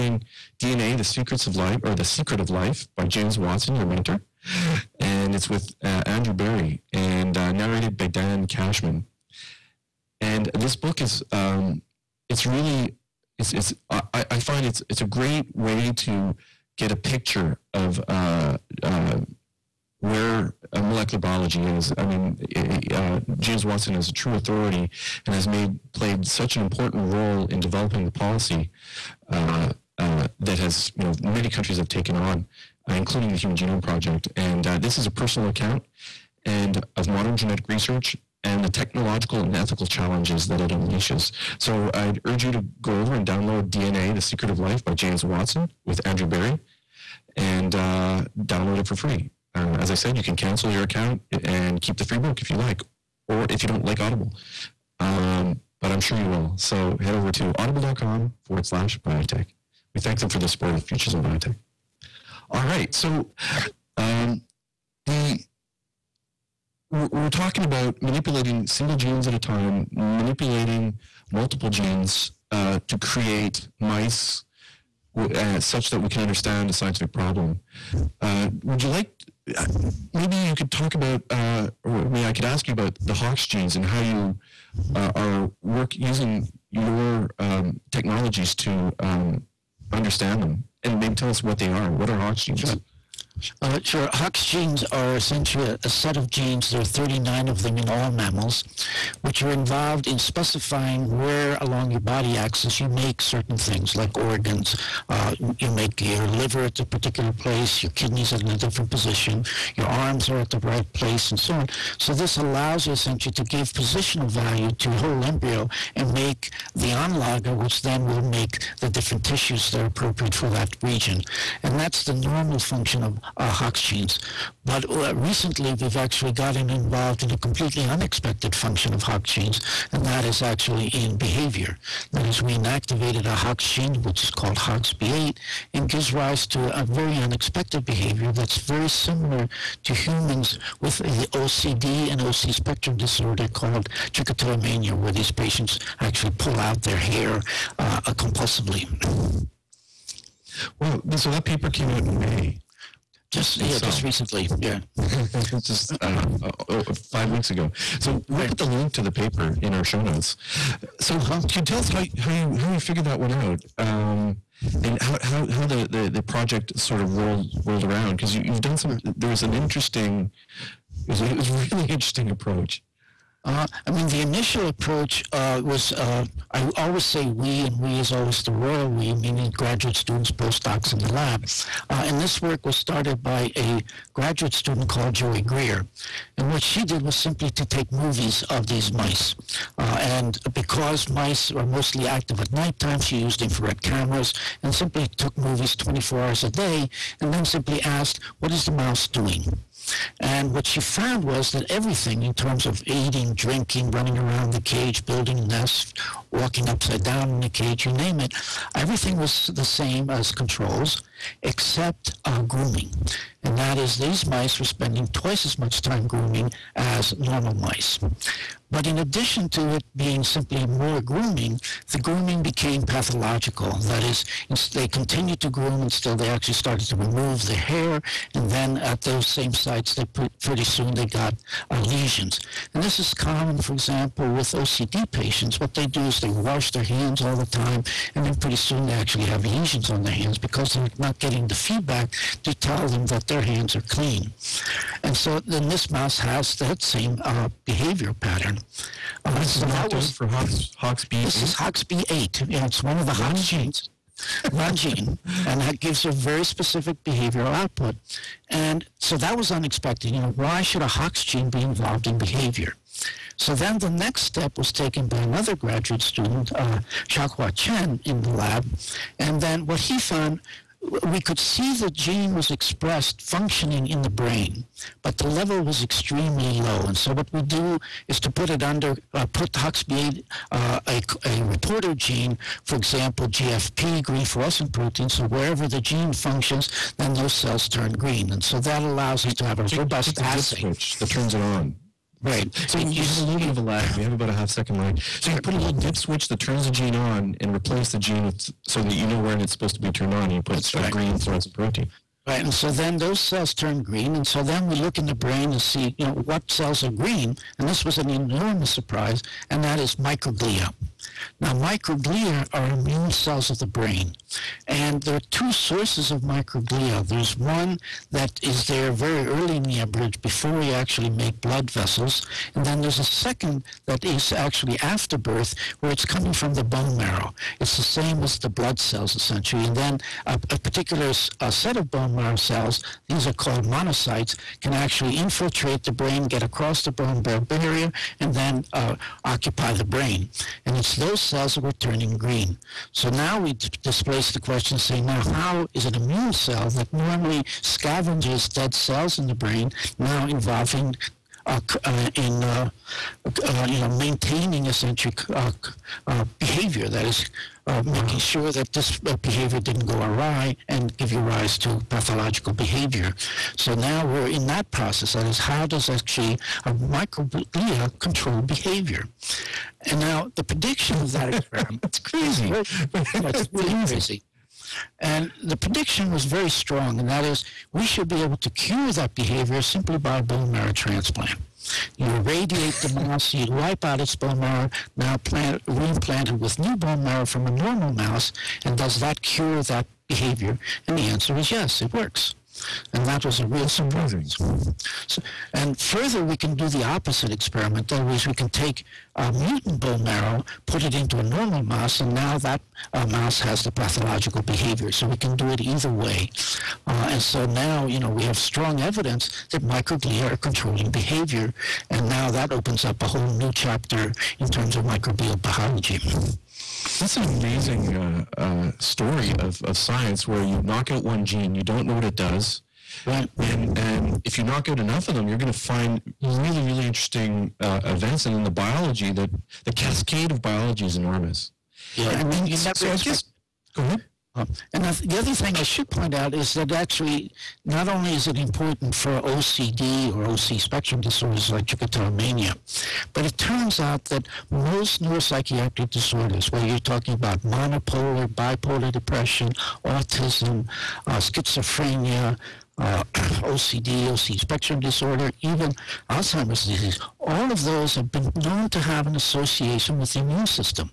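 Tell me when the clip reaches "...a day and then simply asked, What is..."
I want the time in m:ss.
3:16.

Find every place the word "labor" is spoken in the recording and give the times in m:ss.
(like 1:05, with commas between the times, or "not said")
not said.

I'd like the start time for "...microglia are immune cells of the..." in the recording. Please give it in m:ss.
5:11.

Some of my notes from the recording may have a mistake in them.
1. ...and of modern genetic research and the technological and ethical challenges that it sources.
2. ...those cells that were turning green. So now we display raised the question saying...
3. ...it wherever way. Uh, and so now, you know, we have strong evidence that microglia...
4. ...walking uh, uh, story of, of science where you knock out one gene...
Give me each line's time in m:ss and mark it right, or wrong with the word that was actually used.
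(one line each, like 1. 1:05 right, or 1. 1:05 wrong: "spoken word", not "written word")
1. 0:36 wrong: "unleashes", not "sources"
2. 5:40 right
3. 6:45 wrong: "either", not "wherever"
4. 6:57 wrong: "amazing", not "walking".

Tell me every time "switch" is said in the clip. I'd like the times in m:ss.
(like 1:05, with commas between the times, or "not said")
4:50, 4:55.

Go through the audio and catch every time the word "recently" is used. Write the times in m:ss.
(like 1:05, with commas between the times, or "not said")
2:05, 2:34.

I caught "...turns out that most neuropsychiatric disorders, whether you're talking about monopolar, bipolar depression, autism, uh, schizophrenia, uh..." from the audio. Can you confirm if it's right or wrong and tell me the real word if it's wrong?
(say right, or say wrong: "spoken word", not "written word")
right.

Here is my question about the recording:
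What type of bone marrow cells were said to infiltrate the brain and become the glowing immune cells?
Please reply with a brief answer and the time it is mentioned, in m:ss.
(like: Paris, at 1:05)
monocytes, at 5:33.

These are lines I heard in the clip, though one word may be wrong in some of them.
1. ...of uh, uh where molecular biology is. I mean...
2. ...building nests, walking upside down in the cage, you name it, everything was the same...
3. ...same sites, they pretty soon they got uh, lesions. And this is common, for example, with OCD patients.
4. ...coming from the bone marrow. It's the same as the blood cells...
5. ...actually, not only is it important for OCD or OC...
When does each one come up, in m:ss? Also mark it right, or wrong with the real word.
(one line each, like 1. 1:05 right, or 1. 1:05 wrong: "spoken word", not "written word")
1. 0:17 right
2. 3:25 right
3. 3:49 right
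4. 5:26 right
5. 7:16 right.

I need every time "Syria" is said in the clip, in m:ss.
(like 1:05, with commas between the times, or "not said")
not said.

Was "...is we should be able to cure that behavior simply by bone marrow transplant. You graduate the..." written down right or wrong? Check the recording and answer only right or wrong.
wrong.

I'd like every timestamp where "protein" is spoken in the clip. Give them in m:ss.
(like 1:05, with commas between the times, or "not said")
4:44, 5:01.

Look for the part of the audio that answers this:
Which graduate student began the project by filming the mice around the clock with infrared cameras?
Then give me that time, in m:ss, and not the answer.
3:05.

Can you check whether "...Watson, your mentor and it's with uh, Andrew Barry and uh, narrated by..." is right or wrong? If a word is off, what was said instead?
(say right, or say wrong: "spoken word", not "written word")
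right.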